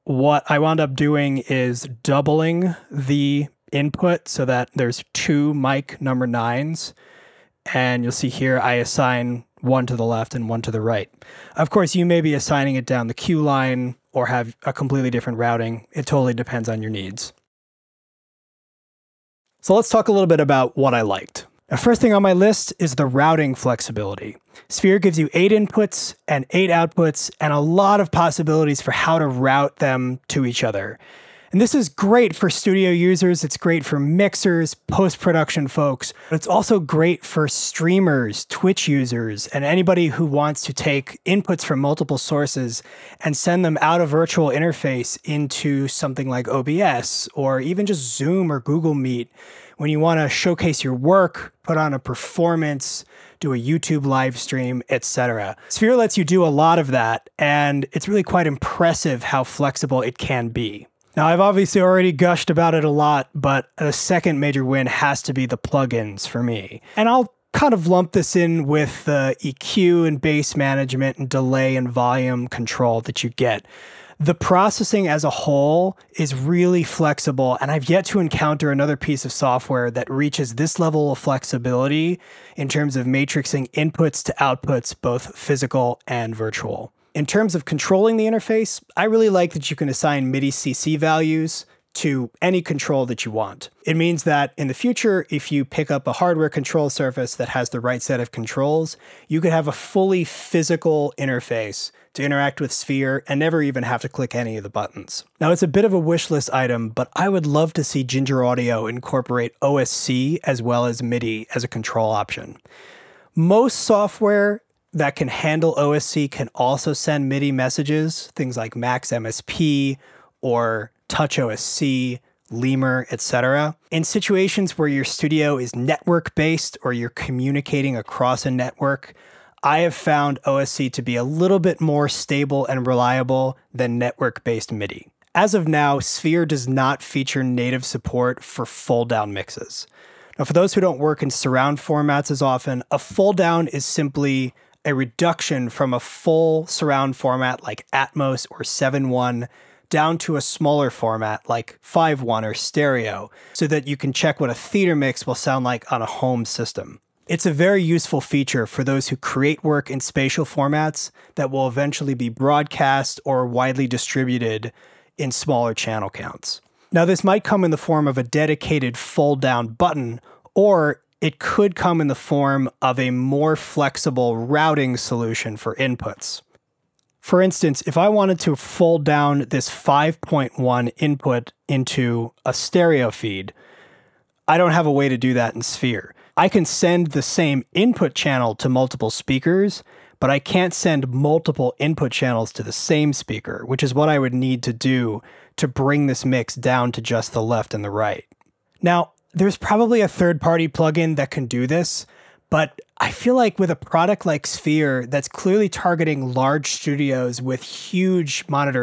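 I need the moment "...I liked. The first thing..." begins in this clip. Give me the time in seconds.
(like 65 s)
20 s.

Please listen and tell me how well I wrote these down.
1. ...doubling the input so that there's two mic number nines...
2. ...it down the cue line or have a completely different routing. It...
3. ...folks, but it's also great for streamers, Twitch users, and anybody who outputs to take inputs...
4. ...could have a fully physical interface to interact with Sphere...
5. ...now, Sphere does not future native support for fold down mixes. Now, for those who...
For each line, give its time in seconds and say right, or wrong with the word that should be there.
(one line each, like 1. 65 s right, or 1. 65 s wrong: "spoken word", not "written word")
1. 2 s right
2. 12 s right
3. 35 s wrong: "wants", not "outputs"
4. 99 s right
5. 135 s wrong: "feature", not "future".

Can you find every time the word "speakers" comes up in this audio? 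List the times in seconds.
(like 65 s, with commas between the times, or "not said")
189 s, 193 s.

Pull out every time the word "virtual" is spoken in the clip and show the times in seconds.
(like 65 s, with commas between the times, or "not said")
44 s, 86 s.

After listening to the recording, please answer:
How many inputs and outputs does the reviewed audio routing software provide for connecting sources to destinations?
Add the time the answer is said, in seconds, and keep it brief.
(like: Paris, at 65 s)
8, at 25 s.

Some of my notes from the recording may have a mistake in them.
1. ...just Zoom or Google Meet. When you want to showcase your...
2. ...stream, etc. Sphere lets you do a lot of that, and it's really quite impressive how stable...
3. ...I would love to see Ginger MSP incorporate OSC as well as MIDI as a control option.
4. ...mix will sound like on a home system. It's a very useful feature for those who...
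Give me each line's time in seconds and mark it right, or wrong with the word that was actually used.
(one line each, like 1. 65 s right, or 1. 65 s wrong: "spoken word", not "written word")
1. 47 s right
2. 54 s wrong: "flexible", not "stable"
3. 107 s wrong: "Audio", not "MSP"
4. 154 s right.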